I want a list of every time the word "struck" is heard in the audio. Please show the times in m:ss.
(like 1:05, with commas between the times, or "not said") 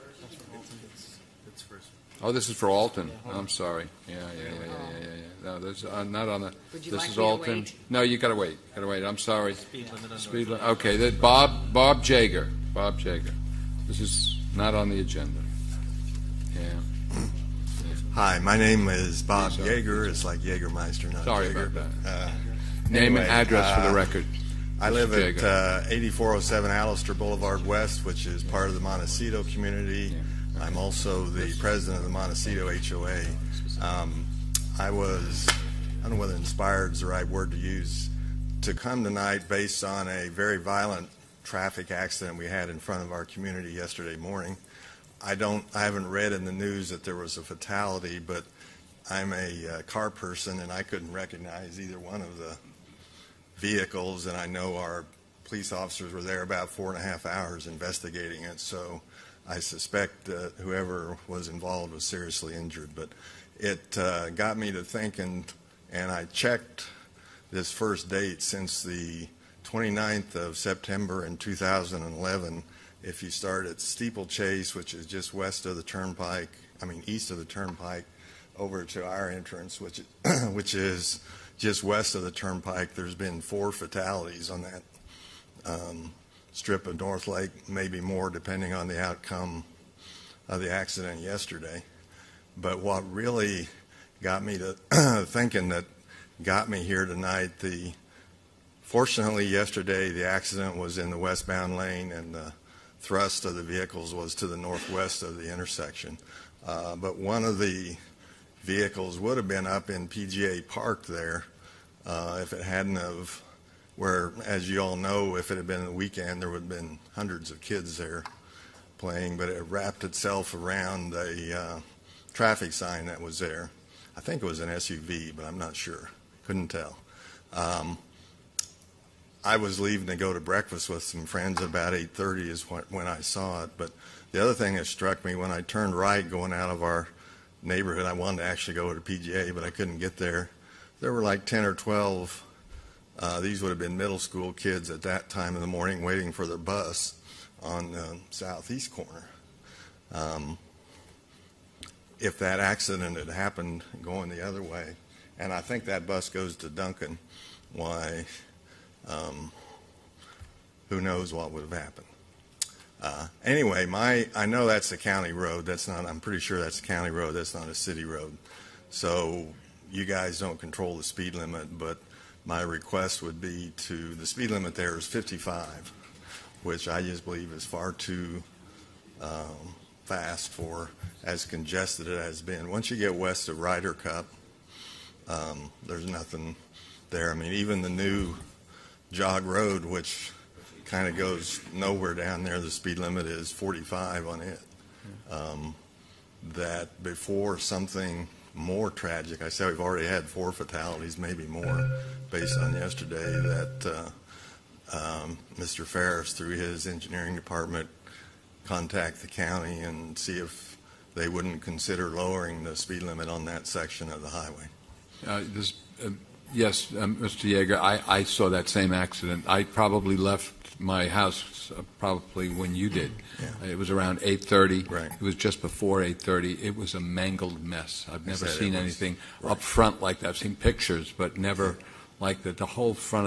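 2:14.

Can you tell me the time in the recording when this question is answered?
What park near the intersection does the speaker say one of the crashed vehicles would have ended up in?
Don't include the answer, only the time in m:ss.
1:50.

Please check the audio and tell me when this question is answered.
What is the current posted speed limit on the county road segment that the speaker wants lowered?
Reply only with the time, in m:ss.
2:55.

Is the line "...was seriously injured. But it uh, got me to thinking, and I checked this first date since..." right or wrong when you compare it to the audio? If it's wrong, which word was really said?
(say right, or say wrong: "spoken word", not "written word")
right.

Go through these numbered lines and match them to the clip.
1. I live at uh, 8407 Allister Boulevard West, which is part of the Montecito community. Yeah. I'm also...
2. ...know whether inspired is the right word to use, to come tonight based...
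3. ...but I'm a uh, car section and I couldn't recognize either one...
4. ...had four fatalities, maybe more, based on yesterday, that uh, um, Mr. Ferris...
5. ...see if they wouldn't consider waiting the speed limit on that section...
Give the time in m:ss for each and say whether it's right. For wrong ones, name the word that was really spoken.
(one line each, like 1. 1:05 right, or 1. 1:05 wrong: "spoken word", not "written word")
1. 0:24 right
2. 0:36 right
3. 0:48 wrong: "person", not "section"
4. 3:20 right
5. 3:30 wrong: "lowering", not "waiting".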